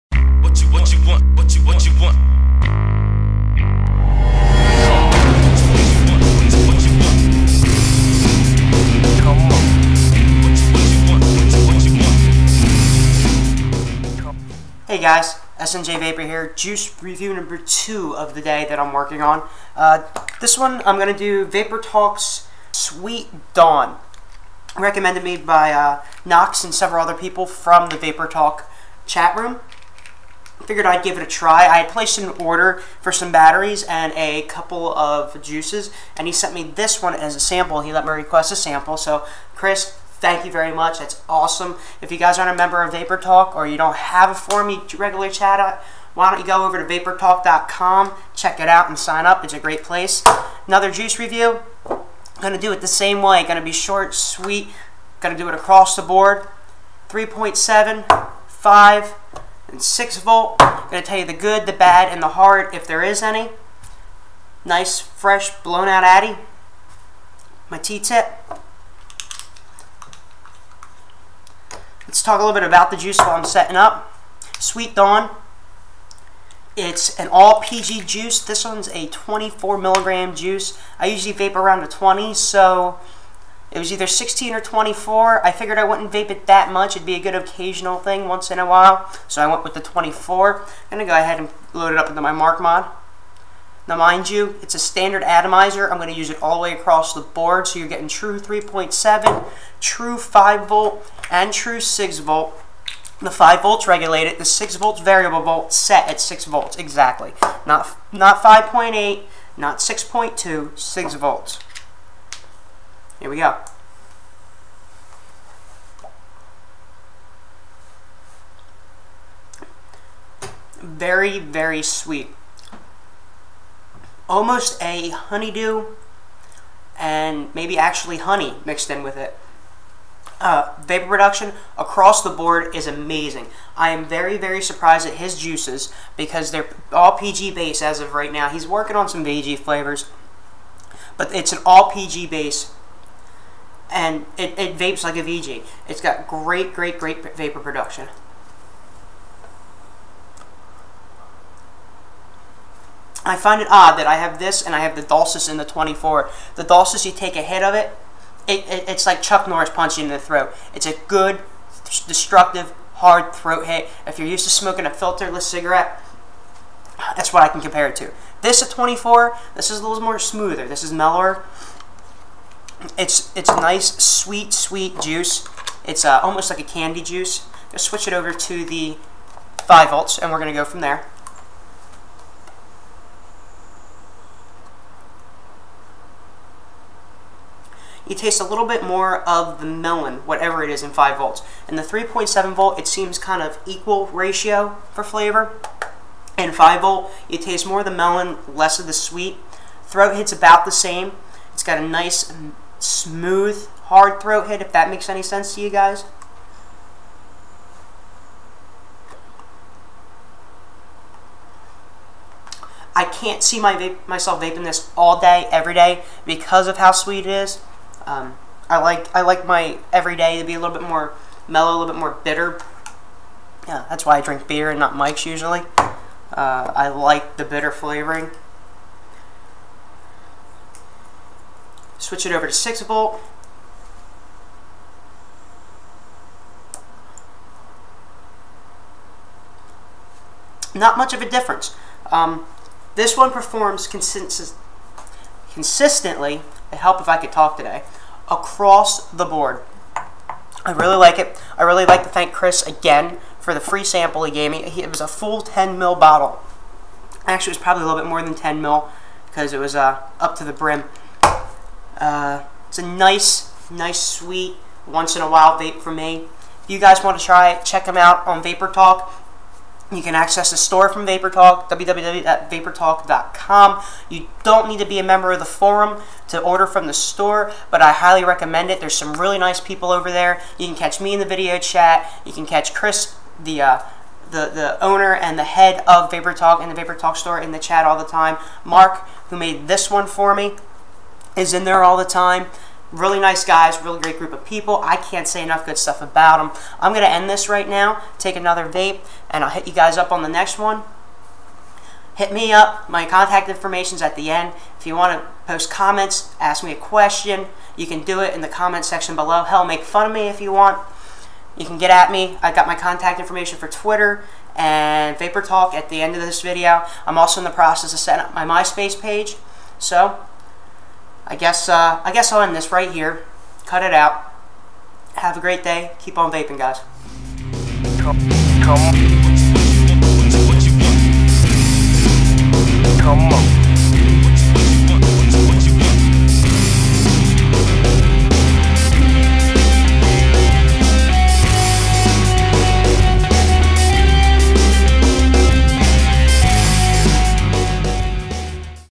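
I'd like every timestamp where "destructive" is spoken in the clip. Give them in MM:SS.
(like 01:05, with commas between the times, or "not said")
02:41.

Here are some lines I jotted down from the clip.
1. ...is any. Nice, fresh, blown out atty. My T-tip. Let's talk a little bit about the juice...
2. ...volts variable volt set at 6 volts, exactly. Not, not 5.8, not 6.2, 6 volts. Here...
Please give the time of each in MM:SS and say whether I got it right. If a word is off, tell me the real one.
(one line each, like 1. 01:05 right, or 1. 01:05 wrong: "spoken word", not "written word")
1. 01:03 right
2. 01:44 right.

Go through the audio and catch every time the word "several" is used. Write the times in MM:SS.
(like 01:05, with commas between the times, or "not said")
00:26.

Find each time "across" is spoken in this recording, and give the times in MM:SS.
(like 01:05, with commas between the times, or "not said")
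00:55, 01:36, 02:11, 04:08.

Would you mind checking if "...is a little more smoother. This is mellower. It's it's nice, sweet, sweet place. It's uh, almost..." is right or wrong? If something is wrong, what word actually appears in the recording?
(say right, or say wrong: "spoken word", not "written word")
wrong: "juice", not "place".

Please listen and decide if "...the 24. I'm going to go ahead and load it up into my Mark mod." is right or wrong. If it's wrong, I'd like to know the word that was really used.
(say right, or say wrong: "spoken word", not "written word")
right.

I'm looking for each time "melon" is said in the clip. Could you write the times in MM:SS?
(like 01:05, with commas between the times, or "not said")
03:09, 03:17.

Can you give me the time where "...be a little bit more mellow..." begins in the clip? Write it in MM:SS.
03:40.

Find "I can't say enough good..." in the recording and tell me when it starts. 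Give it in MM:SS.
04:54.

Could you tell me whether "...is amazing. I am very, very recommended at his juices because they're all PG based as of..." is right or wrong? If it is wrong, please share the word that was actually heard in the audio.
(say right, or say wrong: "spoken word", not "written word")
wrong: "surprised", not "recommended".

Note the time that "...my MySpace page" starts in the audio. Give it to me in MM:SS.
05:18.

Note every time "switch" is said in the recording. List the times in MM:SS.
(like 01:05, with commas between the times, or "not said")
02:57, 03:52.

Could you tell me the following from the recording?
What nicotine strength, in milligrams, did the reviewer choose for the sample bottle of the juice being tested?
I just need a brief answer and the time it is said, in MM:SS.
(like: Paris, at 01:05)
24, at 01:19.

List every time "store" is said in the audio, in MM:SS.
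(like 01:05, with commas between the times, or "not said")
04:30, 04:36, 04:47.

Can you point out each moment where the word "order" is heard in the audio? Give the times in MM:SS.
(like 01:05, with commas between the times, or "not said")
00:32, 04:36.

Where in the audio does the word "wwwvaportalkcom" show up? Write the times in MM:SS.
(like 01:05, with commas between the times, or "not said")
04:31.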